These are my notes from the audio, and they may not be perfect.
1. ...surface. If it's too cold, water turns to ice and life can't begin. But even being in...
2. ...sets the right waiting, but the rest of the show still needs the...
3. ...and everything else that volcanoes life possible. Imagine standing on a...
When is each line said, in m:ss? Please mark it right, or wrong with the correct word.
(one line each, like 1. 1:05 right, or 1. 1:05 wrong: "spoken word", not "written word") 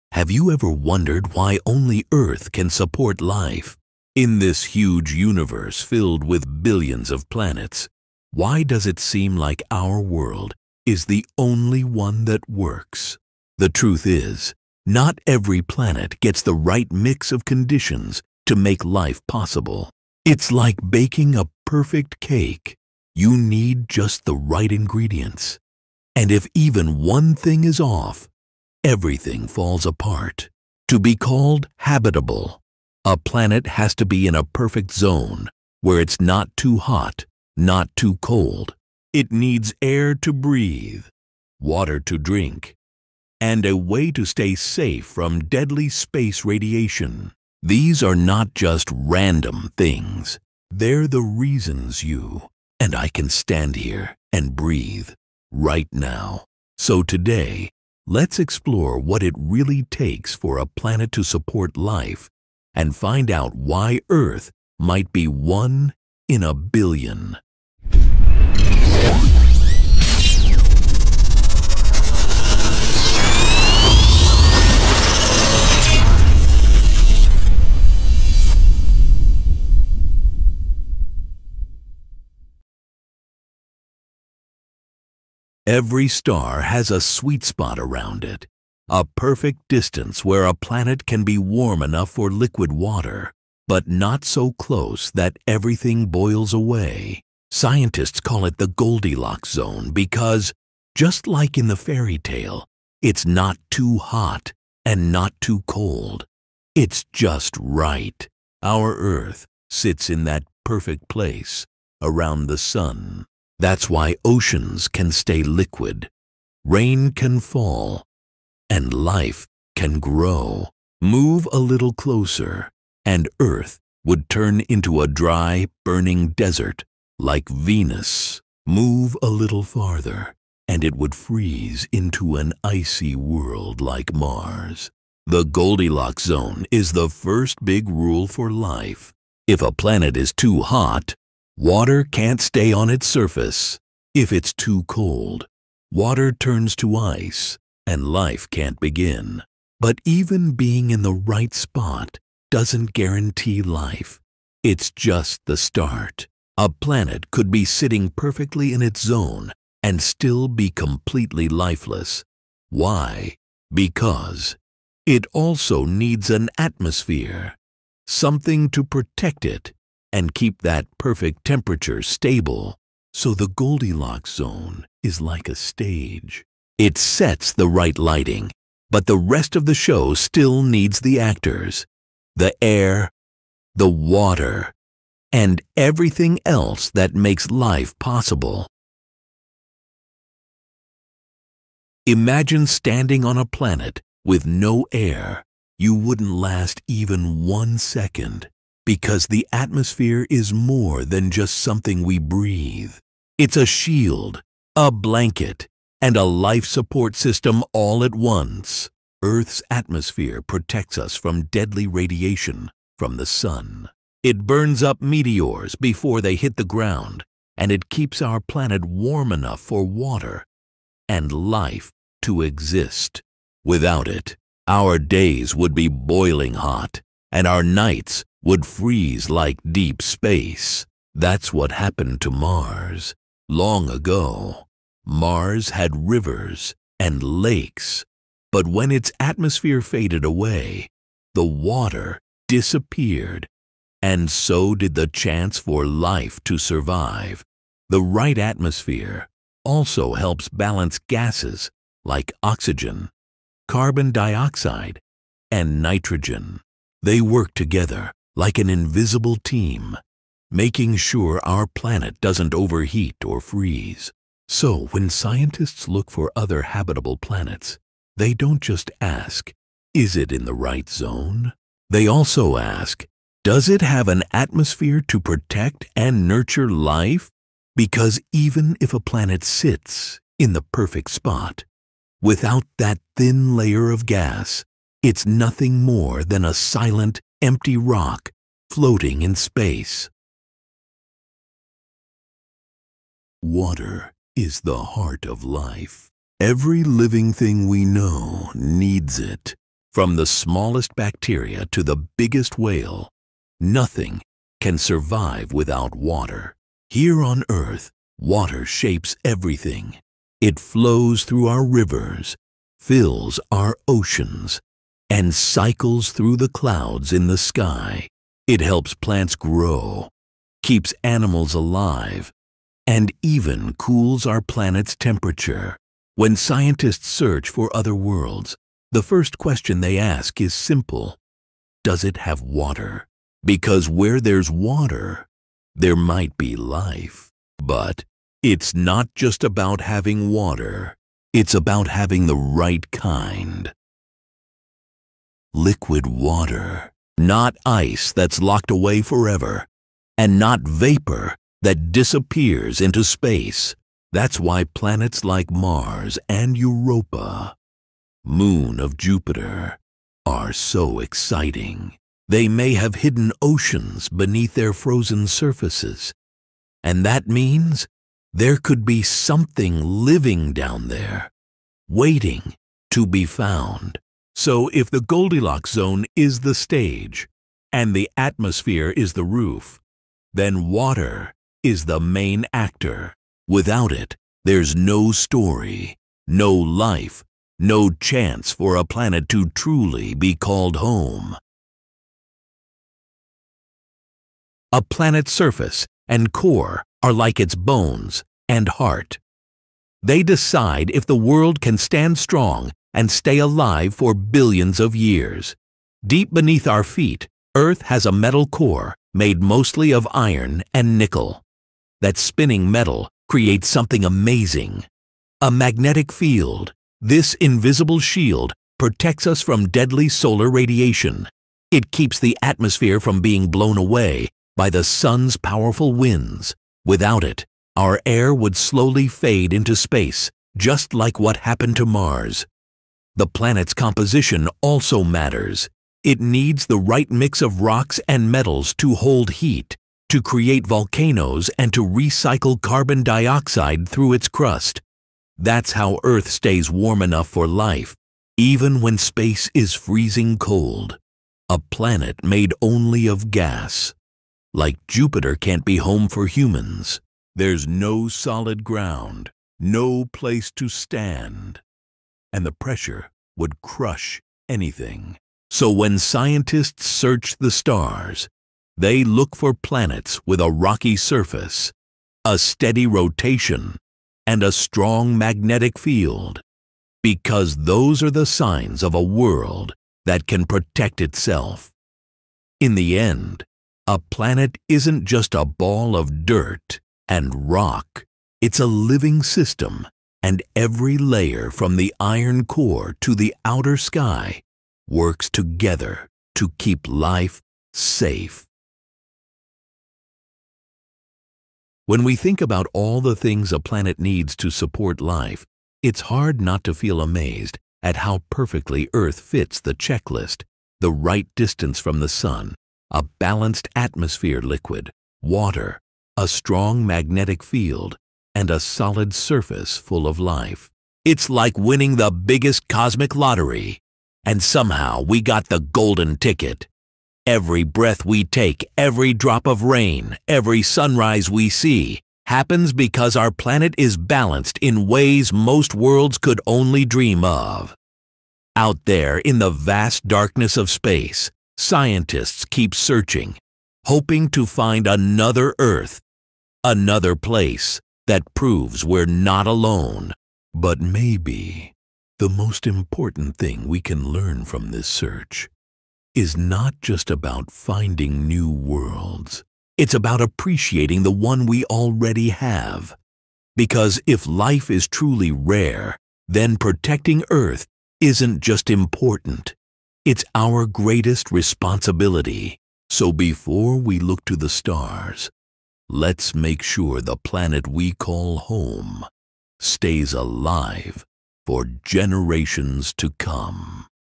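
1. 2:23 right
2. 2:56 wrong: "lighting", not "waiting"
3. 3:05 wrong: "makes", not "volcanoes".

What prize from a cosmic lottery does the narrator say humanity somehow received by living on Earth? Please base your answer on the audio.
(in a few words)
The golden ticket.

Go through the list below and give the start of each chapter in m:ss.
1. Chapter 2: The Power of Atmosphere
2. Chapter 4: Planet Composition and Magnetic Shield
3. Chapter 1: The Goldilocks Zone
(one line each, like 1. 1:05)
1. 3:10
2. 6:33
3. 1:24.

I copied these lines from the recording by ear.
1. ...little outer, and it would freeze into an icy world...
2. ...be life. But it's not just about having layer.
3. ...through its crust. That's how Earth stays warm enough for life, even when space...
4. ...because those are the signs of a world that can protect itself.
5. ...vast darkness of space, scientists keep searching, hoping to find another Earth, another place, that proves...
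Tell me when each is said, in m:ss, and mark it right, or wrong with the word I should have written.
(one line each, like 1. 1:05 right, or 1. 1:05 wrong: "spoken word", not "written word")
1. 2:09 wrong: "farther", not "outer"
2. 5:36 wrong: "water", not "layer"
3. 7:23 right
4. 7:57 right
5. 8:59 right.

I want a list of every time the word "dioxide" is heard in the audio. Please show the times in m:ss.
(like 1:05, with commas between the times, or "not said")
4:14, 7:23.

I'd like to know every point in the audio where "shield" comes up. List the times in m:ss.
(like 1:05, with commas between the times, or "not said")
3:23, 6:57.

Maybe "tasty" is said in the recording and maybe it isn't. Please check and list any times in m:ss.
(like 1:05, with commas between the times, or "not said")
not said.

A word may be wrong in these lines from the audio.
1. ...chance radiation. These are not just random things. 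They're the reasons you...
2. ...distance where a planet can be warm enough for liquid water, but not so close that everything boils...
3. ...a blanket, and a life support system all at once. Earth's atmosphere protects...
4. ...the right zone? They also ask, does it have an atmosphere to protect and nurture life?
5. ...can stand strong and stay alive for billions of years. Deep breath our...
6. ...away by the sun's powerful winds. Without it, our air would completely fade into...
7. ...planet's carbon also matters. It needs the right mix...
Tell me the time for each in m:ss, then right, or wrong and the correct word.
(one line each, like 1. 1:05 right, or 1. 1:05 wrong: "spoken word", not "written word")
1. 0:45 wrong: "space", not "chance"
2. 1:29 right
3. 3:24 right
4. 4:30 right
5. 6:41 wrong: "beneath", not "breath"
6. 7:03 wrong: "slowly", not "completely"
7. 7:13 wrong: "composition", not "carbon".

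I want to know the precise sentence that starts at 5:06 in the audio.
Here on Earth, water shapes everything.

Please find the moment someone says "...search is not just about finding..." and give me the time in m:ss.
9:14.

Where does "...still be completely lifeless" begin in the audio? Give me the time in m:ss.
2:40.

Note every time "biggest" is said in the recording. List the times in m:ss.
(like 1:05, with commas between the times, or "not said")
5:02, 8:42.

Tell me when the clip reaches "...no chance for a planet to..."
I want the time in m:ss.
6:27.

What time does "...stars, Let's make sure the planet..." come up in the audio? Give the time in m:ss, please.
9:34.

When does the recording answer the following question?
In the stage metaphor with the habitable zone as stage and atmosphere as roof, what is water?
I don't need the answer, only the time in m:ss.
6:21.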